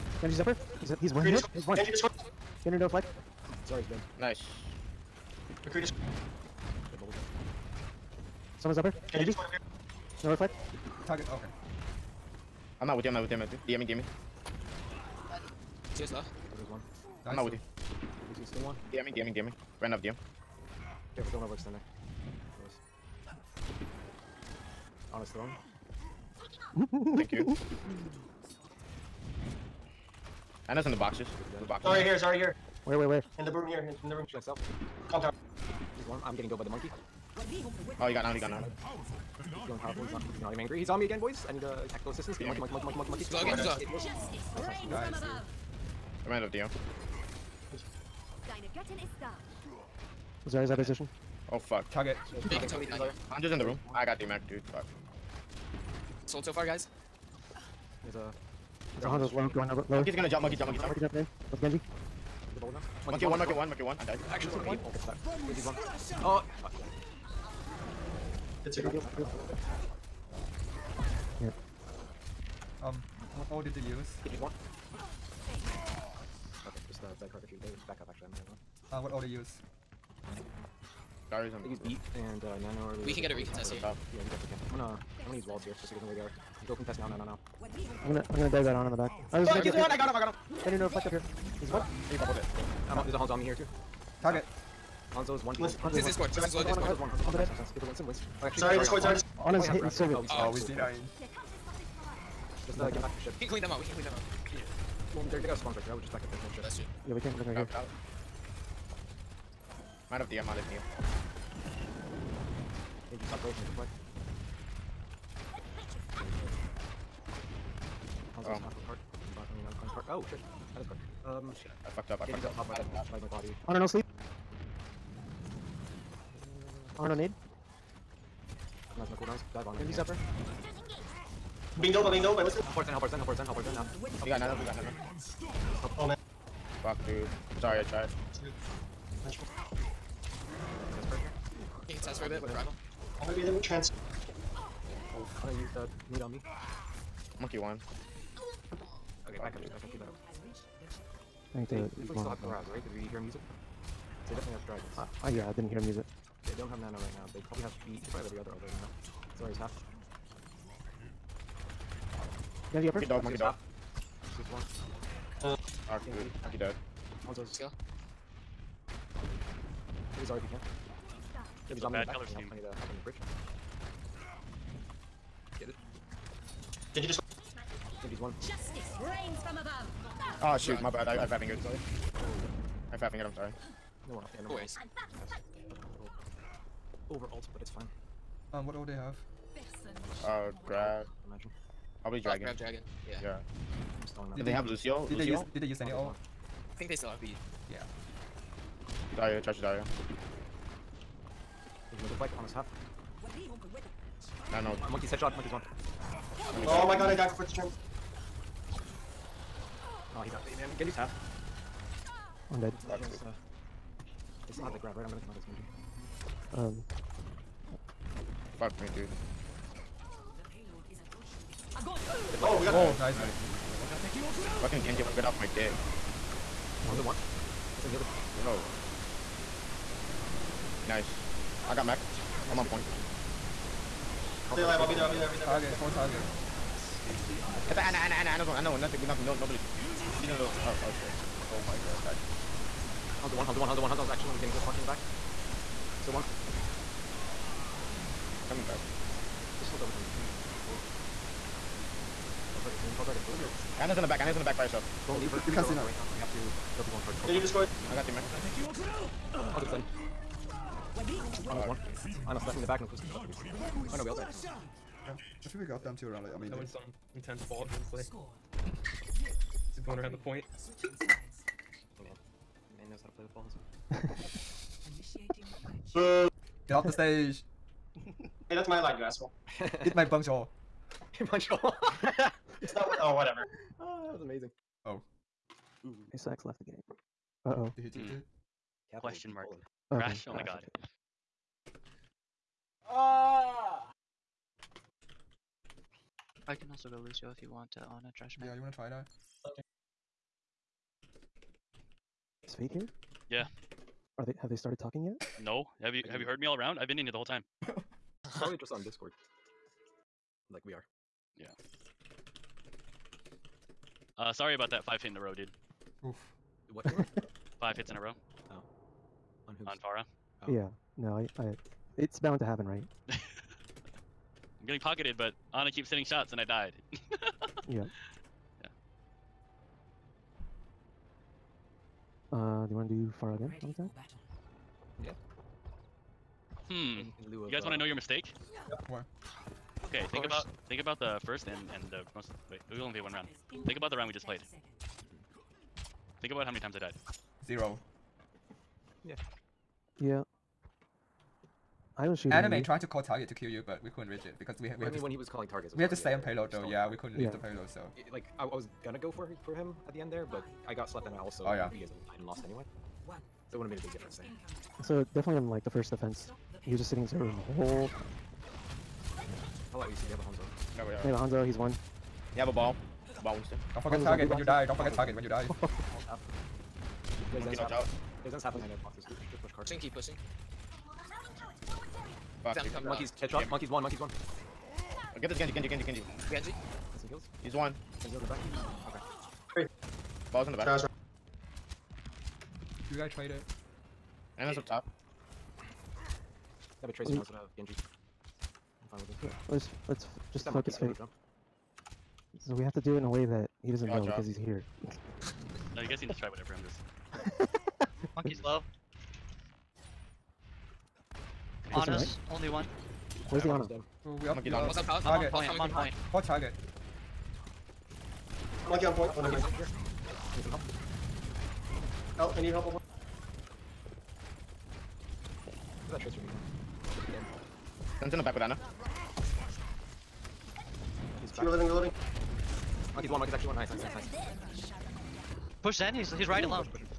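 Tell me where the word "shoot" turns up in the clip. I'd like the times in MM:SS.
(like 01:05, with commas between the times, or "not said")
00:34, 03:00.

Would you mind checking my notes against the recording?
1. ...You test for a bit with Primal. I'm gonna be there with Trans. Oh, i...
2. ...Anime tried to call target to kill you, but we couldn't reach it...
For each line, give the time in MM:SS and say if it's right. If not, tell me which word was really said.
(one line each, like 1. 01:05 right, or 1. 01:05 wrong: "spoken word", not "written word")
1. 02:21 right
2. 05:52 right.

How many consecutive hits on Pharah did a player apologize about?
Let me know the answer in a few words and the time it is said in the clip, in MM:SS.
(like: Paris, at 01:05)
5, at 05:17.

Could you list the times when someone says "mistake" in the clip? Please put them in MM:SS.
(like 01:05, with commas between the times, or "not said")
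05:37.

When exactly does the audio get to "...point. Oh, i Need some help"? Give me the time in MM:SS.
06:58.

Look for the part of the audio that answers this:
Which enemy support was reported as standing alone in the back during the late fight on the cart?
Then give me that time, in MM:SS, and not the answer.
04:14.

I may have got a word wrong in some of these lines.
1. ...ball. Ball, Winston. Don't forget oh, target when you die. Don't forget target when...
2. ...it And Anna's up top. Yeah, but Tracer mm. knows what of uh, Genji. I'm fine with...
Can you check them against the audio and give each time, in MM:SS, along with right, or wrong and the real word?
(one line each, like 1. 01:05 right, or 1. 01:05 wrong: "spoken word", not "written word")
1. 06:12 right
2. 06:33 right.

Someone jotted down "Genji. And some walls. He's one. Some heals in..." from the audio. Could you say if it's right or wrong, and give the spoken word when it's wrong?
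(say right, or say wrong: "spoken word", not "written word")
wrong: "heals", not "walls".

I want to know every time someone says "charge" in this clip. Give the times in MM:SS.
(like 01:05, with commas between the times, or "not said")
03:19.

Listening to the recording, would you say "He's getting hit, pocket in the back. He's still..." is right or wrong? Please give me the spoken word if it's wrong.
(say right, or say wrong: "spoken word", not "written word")
right.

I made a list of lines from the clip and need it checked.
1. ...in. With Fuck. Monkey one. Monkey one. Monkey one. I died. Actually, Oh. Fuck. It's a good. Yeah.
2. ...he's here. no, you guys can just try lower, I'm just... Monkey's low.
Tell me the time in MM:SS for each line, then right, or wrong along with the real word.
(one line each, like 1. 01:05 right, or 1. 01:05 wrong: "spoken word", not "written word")
1. 01:01 wrong: "Genji", not "Fuck"
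2. 06:44 wrong: "whatever", not "lower".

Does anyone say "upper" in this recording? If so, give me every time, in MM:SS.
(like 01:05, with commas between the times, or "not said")
00:00, 00:08, 02:09, 02:42.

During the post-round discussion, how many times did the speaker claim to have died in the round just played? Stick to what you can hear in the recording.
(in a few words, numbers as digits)
Zero.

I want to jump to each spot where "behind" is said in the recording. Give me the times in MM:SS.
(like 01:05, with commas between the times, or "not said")
01:35, 06:18.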